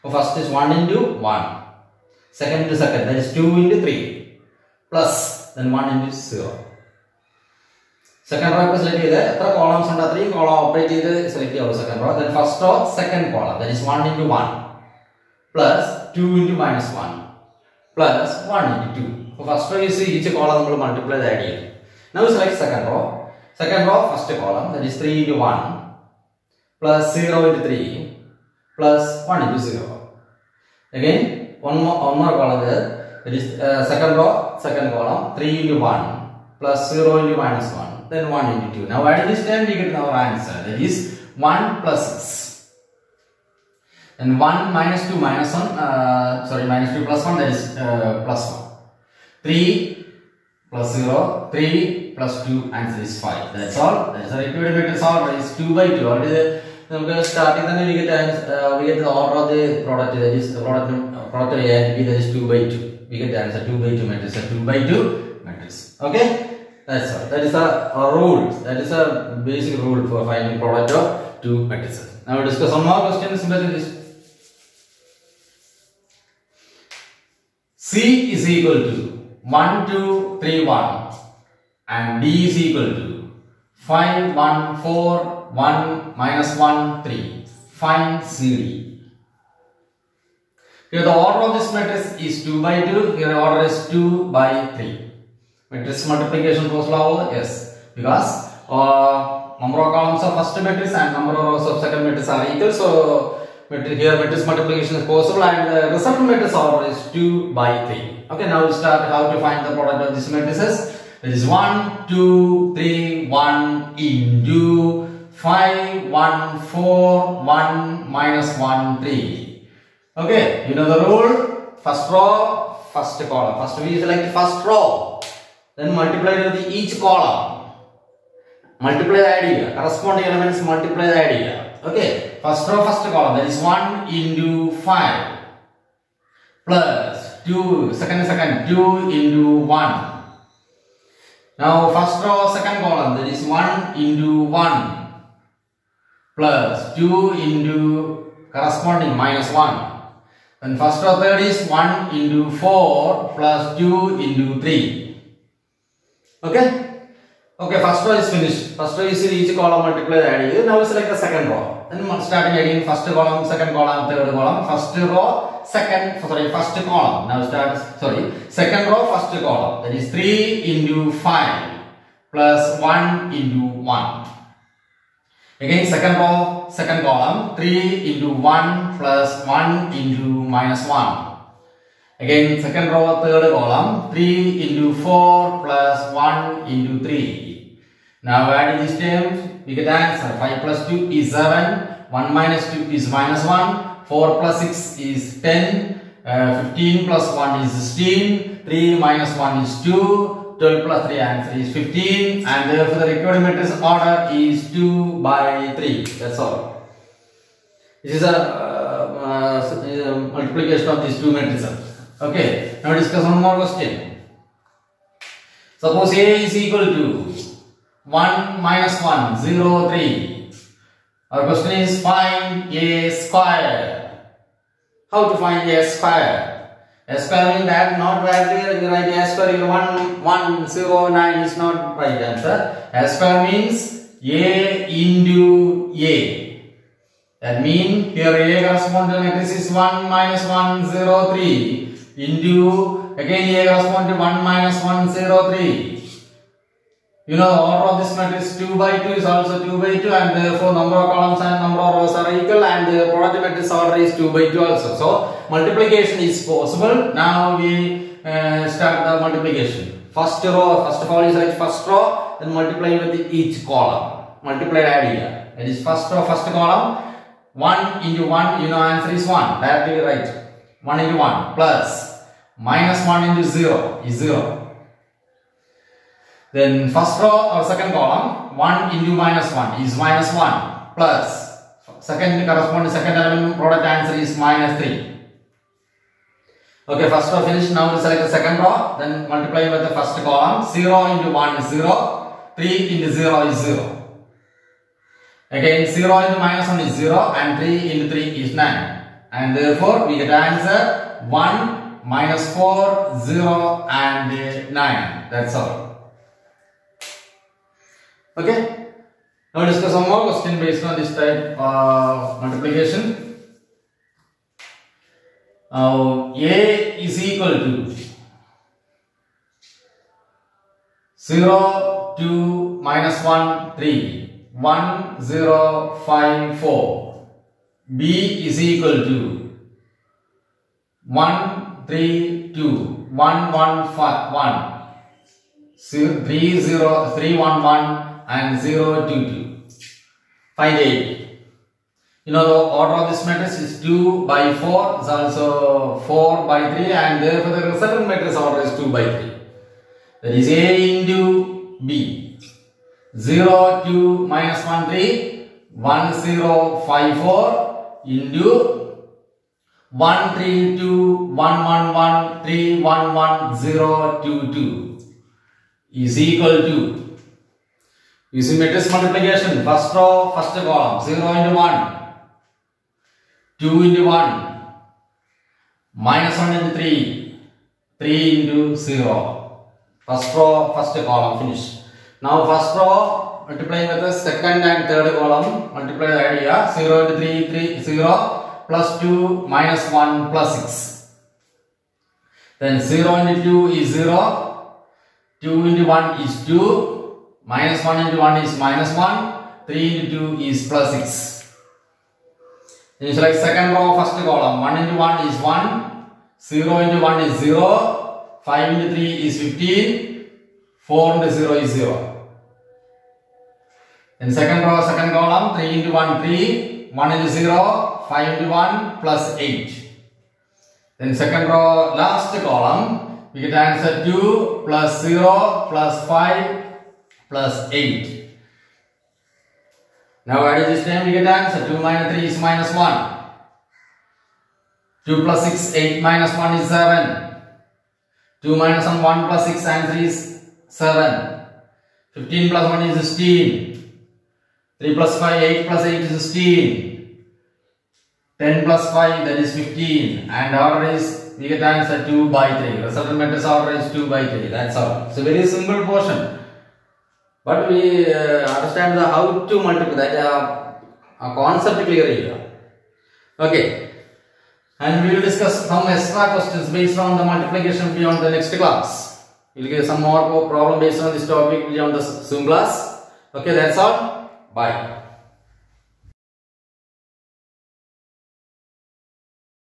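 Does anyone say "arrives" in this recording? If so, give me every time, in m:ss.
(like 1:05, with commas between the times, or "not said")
not said.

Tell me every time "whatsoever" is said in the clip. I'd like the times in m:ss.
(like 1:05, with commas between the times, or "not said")
not said.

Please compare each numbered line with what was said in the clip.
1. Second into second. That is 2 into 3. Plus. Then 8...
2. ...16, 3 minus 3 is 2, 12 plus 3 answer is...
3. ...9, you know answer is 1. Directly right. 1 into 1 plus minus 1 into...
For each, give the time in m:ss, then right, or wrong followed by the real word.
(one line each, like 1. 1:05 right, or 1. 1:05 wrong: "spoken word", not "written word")
1. 0:02 wrong: "1", not "8"
2. 3:17 wrong: "1", not "3"
3. 4:28 wrong: "1", not "9".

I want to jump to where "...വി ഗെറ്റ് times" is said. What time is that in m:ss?
0:57.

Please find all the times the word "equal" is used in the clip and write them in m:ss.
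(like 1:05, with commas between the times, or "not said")
1:18, 1:22, 1:42, 3:36, 4:12, 5:17, 5:28, 6:06.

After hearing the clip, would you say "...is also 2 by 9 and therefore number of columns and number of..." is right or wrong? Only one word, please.
wrong.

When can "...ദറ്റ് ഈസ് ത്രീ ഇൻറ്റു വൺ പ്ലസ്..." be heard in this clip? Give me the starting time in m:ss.
0:24.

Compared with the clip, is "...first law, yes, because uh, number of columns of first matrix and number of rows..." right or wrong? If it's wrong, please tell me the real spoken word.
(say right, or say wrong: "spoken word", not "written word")
right.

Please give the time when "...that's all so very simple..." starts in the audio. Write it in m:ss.
7:34.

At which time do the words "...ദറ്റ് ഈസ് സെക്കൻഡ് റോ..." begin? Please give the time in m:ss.
0:32.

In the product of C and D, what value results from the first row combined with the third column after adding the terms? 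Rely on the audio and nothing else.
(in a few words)
10.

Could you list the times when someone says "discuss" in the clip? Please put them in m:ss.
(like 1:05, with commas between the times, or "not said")
1:12, 3:32, 5:09, 7:45.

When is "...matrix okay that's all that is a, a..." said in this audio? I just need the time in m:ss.
1:05.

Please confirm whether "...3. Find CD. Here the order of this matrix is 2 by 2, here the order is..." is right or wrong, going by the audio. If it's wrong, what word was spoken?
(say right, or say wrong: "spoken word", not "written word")
right.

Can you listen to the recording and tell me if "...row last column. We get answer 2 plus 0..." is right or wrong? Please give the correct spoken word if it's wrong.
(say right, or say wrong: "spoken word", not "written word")
right.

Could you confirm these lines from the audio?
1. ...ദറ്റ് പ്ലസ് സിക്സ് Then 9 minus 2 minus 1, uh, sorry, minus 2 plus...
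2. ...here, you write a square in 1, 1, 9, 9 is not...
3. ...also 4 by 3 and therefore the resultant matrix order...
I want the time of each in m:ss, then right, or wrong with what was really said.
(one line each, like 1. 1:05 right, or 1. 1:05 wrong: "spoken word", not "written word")
1. 0:40 wrong: "1", not "9"
2. 3:48 wrong: "0", not "9"
3. 5:45 right.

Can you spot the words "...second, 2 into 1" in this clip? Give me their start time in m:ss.
2:18.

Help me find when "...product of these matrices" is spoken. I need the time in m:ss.
1:49.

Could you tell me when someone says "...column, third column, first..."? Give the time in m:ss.
2:43.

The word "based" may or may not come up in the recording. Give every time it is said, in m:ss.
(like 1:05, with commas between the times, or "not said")
5:10, 7:46, 7:50.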